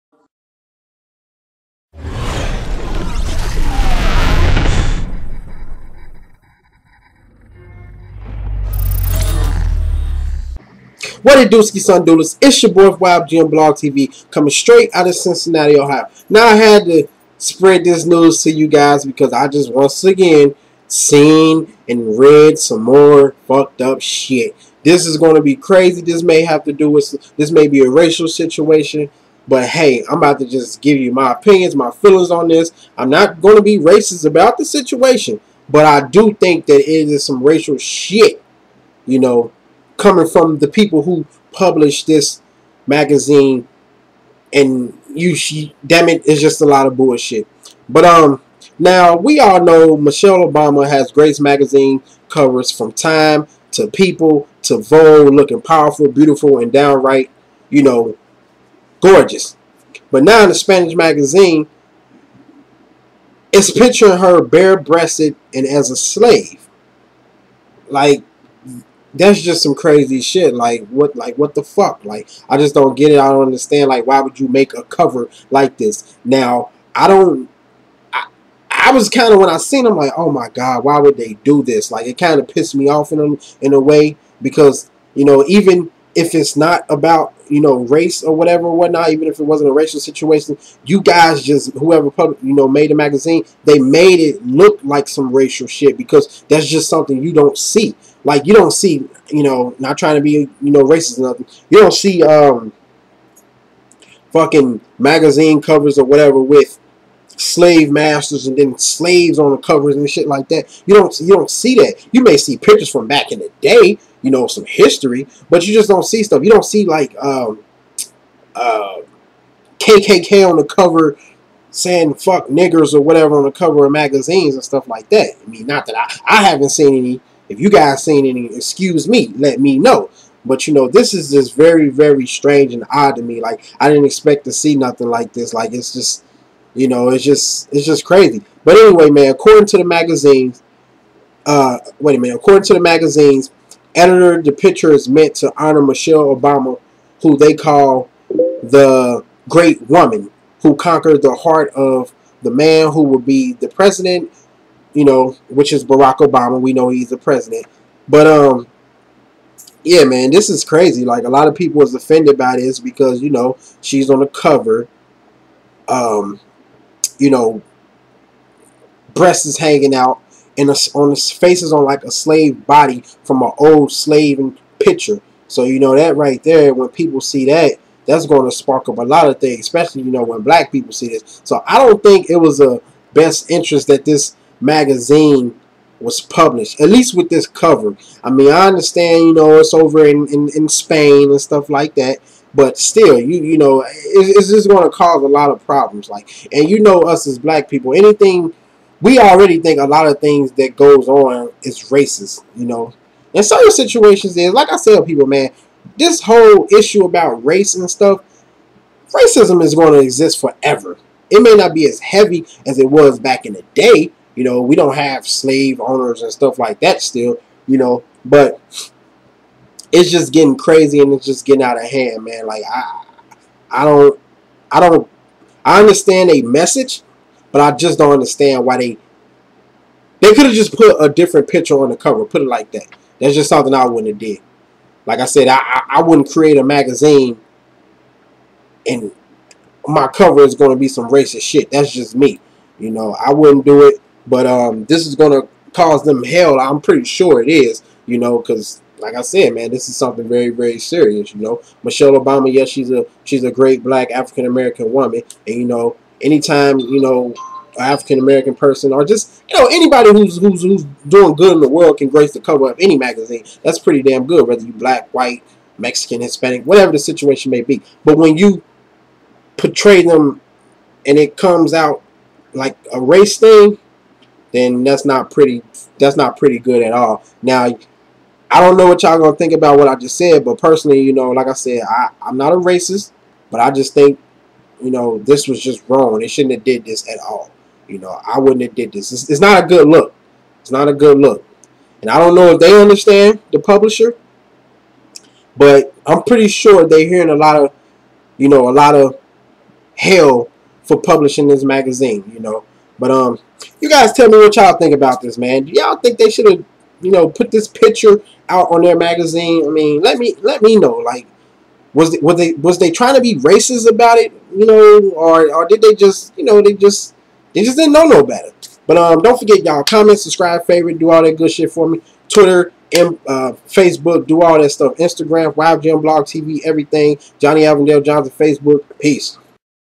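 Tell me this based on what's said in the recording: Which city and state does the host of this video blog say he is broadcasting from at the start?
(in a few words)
Cincinnati, Ohio.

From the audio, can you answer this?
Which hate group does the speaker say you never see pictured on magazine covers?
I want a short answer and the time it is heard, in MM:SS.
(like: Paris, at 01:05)
KKK, at 01:59.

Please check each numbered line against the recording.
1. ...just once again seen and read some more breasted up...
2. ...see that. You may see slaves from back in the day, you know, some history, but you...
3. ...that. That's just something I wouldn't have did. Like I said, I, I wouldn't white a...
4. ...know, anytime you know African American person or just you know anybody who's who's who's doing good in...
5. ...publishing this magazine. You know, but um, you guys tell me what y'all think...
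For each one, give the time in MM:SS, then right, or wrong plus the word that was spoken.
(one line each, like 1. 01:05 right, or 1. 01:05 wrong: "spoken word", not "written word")
1. 00:19 wrong: "fucked", not "breasted"
2. 01:51 wrong: "pictures", not "slaves"
3. 03:52 wrong: "create", not "white"
4. 04:15 right
5. 05:00 right.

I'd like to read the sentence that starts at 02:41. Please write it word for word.
Like, a lot of people was offended by this because, you know, she's on the cover.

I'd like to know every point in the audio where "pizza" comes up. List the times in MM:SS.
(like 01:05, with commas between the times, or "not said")
not said.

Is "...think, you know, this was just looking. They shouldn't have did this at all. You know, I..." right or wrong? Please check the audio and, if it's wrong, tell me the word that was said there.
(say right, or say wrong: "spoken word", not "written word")
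wrong: "wrong", not "looking".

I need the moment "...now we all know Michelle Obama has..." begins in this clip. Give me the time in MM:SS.
00:48.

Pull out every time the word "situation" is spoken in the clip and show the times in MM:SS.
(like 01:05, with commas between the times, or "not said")
00:28, 00:34, 01:29, 03:23, 04:26.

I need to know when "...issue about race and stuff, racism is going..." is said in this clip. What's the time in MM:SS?
03:26.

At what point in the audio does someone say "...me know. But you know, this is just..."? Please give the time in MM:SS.
02:09.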